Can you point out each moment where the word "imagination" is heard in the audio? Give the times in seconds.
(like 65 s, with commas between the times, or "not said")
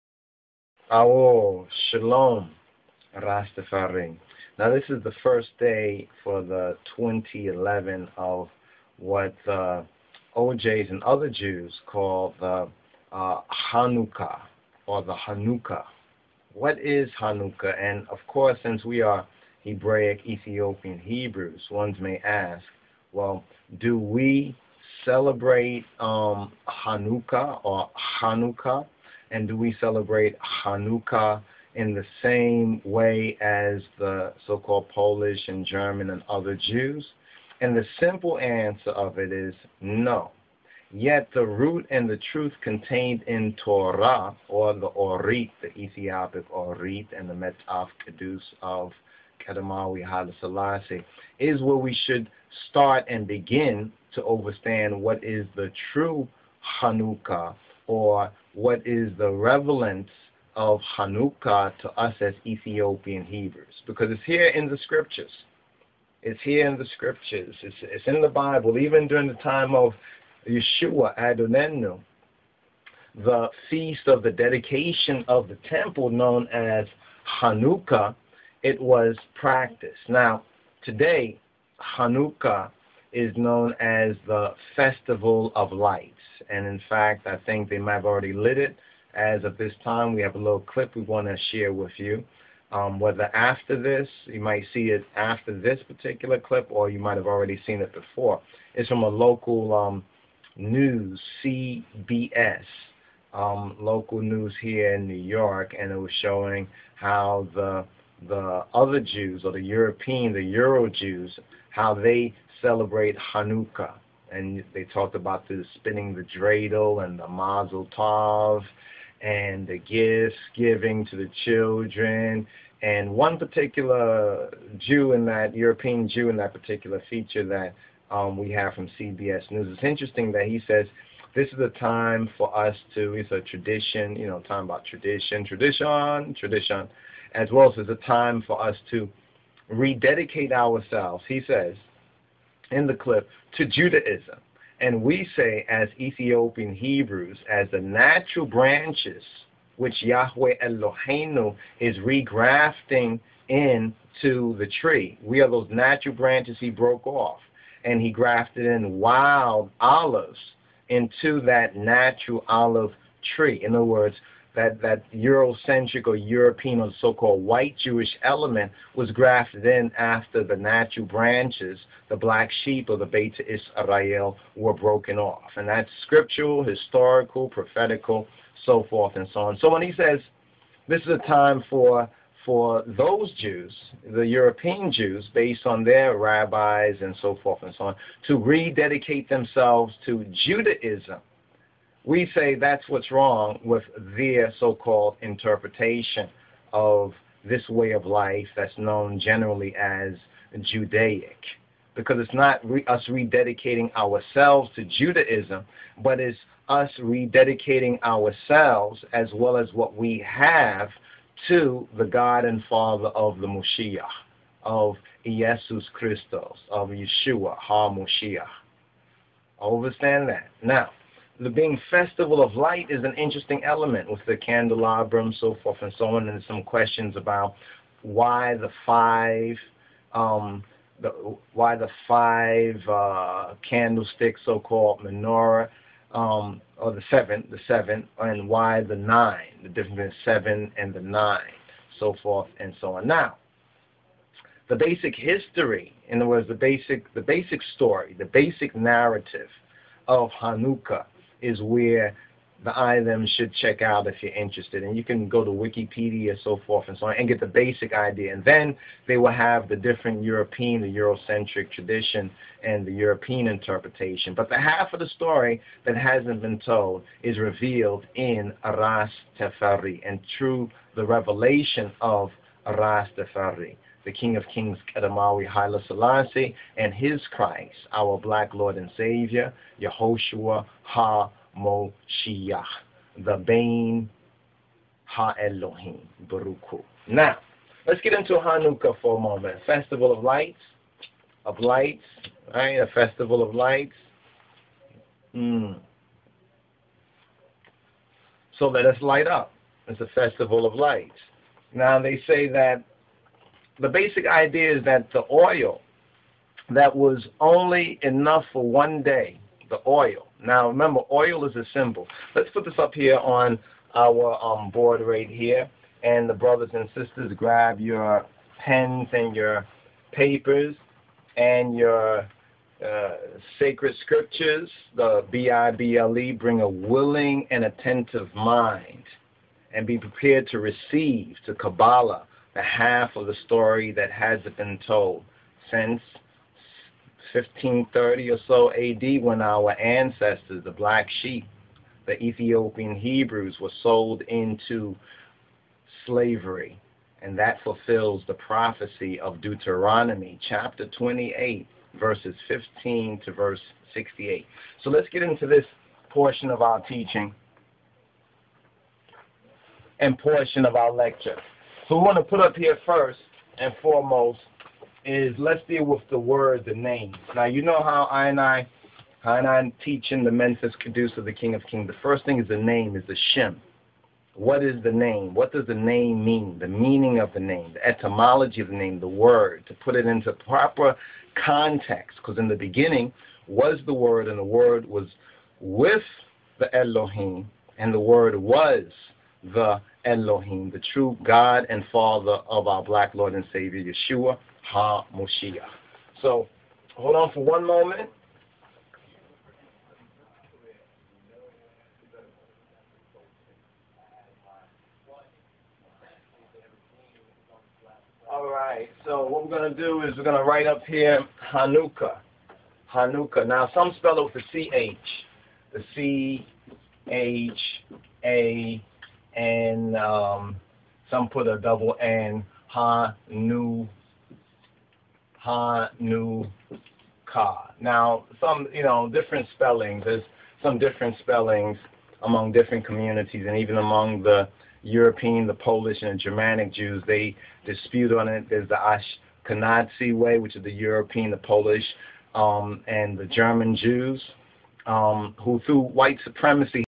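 not said.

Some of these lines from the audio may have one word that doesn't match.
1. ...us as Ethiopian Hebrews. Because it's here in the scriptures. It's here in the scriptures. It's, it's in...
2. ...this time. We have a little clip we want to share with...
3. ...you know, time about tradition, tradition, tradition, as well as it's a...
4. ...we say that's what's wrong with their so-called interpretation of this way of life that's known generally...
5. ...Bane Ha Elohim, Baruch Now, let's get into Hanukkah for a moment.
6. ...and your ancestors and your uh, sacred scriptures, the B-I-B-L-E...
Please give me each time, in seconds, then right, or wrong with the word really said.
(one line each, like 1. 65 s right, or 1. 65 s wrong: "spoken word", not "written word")
1. 61 s right
2. 89 s right
3. 134 s right
4. 192 s right
5. 283 s right
6. 319 s wrong: "papers", not "ancestors".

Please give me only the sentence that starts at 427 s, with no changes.
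Now, some, you know, different spellings.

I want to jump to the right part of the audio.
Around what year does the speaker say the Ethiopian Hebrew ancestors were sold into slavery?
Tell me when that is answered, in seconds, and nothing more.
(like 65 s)
337 s.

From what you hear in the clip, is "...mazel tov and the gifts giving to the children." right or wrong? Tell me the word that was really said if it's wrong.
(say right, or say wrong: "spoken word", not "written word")
right.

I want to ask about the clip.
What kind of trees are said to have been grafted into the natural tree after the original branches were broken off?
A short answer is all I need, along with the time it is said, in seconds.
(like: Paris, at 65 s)
Wild olives, at 158 s.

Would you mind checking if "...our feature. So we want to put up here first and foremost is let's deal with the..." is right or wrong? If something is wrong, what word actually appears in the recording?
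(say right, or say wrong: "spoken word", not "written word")
wrong: "lecture", not "feature".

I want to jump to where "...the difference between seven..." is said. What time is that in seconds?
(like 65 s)
239 s.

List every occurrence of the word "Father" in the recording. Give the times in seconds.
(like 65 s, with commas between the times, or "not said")
212 s, 391 s.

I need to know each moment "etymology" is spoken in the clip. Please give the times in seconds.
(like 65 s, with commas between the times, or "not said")
377 s.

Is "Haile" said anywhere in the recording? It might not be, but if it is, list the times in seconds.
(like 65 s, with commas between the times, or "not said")
50 s, 275 s.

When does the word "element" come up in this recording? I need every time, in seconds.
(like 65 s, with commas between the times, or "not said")
168 s, 223 s.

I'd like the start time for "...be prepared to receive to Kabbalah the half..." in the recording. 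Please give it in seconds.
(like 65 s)
329 s.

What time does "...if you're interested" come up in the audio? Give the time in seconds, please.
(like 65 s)
254 s.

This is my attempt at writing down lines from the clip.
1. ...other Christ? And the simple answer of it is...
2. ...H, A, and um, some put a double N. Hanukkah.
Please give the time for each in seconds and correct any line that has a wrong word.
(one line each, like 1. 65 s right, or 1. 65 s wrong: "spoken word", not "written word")
1. 36 s wrong: "Jews", not "Christ"
2. 417 s right.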